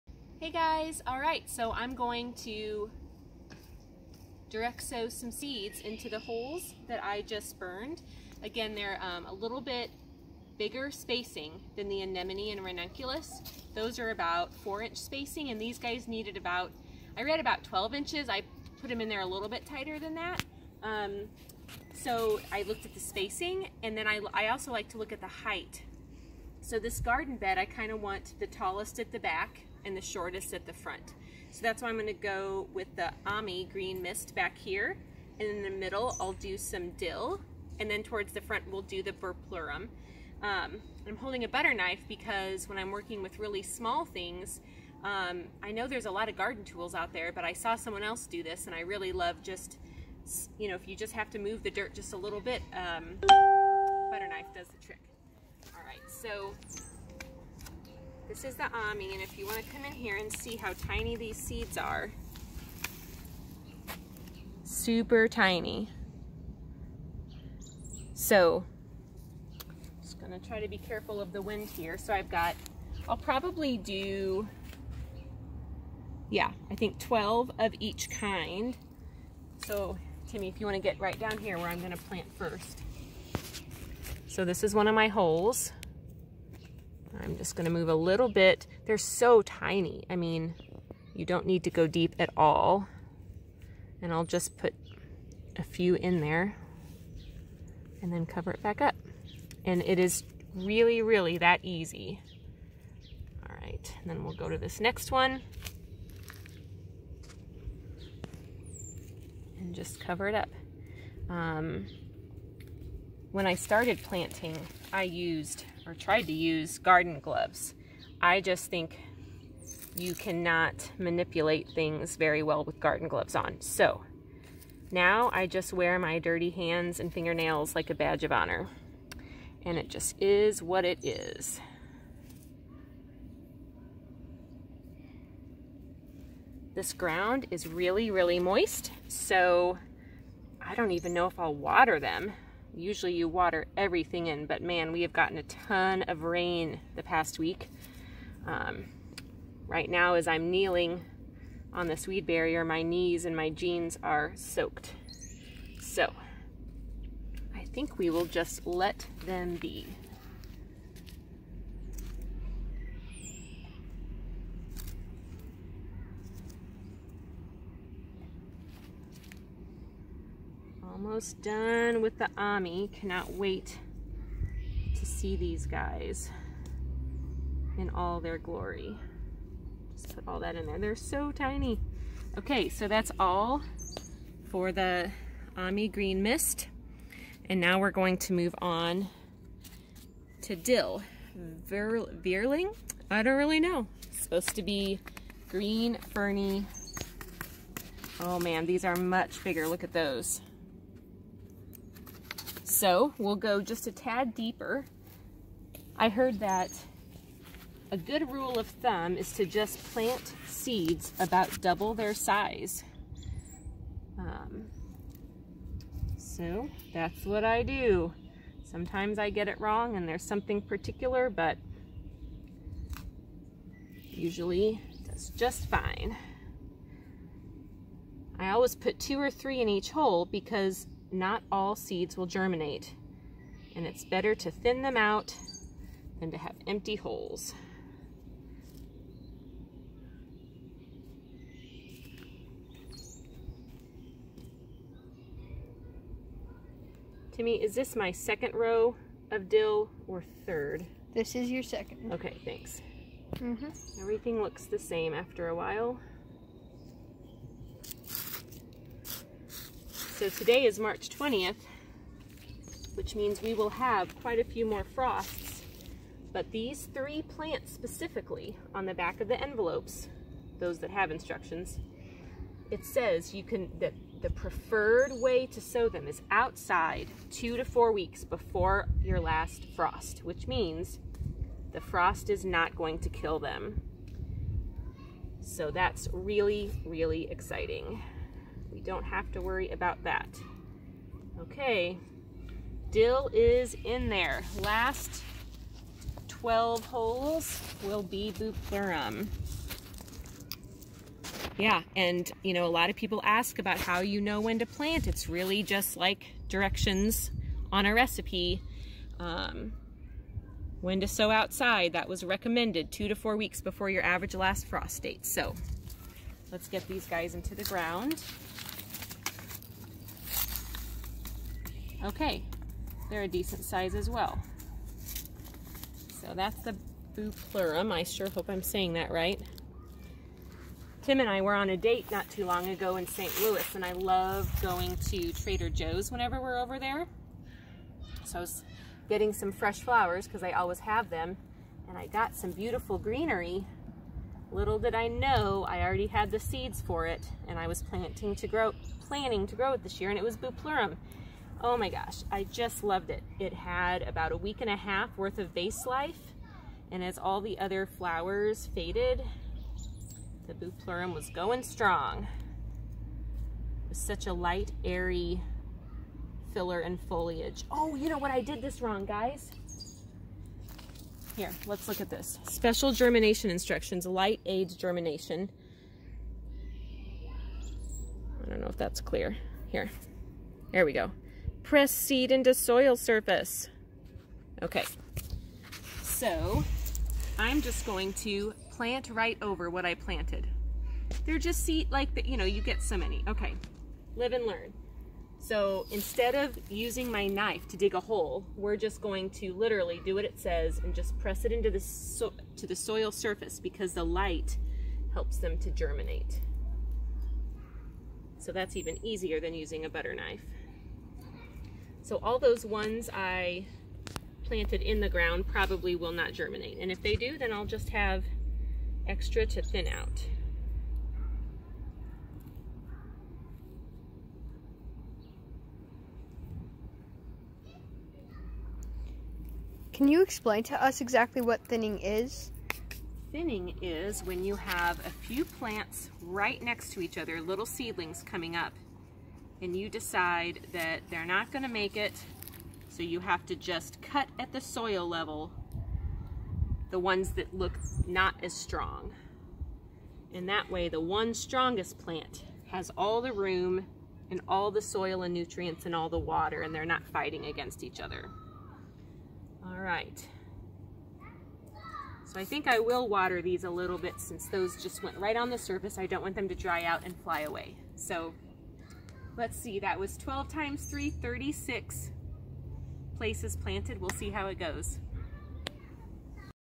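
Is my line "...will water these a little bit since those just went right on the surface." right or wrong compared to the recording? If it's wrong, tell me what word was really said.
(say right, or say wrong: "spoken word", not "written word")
right.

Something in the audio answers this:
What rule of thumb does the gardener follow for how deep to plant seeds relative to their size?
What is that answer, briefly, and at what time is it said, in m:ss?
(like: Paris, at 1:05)
Double their size, at 3:31.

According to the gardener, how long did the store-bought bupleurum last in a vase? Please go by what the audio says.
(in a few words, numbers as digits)
A week and a half.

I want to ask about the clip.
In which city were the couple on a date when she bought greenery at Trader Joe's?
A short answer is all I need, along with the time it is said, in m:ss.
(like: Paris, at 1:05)
St. Louis, at 5:33.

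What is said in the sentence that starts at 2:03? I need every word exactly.
So now I just wear my dirty hands and fingernails like a badge of honor.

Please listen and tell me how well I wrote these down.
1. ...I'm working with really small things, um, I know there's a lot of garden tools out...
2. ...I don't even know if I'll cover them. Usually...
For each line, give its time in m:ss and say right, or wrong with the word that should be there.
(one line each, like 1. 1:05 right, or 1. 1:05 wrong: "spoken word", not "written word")
1. 0:42 right
2. 2:20 wrong: "water", not "cover".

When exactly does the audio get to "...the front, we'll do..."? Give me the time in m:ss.
0:38.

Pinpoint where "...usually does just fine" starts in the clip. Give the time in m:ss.
3:44.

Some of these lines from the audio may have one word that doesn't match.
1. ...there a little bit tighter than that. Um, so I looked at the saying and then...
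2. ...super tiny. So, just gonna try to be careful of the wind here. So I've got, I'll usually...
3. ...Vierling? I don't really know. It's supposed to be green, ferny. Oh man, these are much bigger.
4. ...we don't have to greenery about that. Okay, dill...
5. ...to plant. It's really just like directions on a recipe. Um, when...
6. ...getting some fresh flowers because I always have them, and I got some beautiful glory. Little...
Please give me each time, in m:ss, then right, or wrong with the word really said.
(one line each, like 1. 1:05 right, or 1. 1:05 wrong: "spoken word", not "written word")
1. 0:19 wrong: "spacing", not "saying"
2. 1:04 wrong: "probably", not "usually"
3. 3:12 right
4. 4:48 wrong: "worry", not "greenery"
5. 5:04 right
6. 5:39 wrong: "greenery", not "glory".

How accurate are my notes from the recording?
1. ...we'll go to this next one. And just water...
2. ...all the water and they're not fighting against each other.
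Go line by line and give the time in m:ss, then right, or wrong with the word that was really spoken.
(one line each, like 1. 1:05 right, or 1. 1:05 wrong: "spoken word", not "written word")
1. 1:44 wrong: "cover", not "water"
2. 7:35 right.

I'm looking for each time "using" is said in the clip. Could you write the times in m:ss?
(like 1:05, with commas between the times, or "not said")
6:36, 6:49.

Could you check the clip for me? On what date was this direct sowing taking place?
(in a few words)
March 20th.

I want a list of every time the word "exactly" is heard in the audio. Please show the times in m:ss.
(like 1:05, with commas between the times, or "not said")
7:11.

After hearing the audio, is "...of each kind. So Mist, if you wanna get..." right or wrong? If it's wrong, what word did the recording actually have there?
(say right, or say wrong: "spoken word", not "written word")
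wrong: "Timmy", not "Mist".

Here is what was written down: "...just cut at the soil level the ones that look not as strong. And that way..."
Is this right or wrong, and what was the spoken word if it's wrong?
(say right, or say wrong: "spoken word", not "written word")
right.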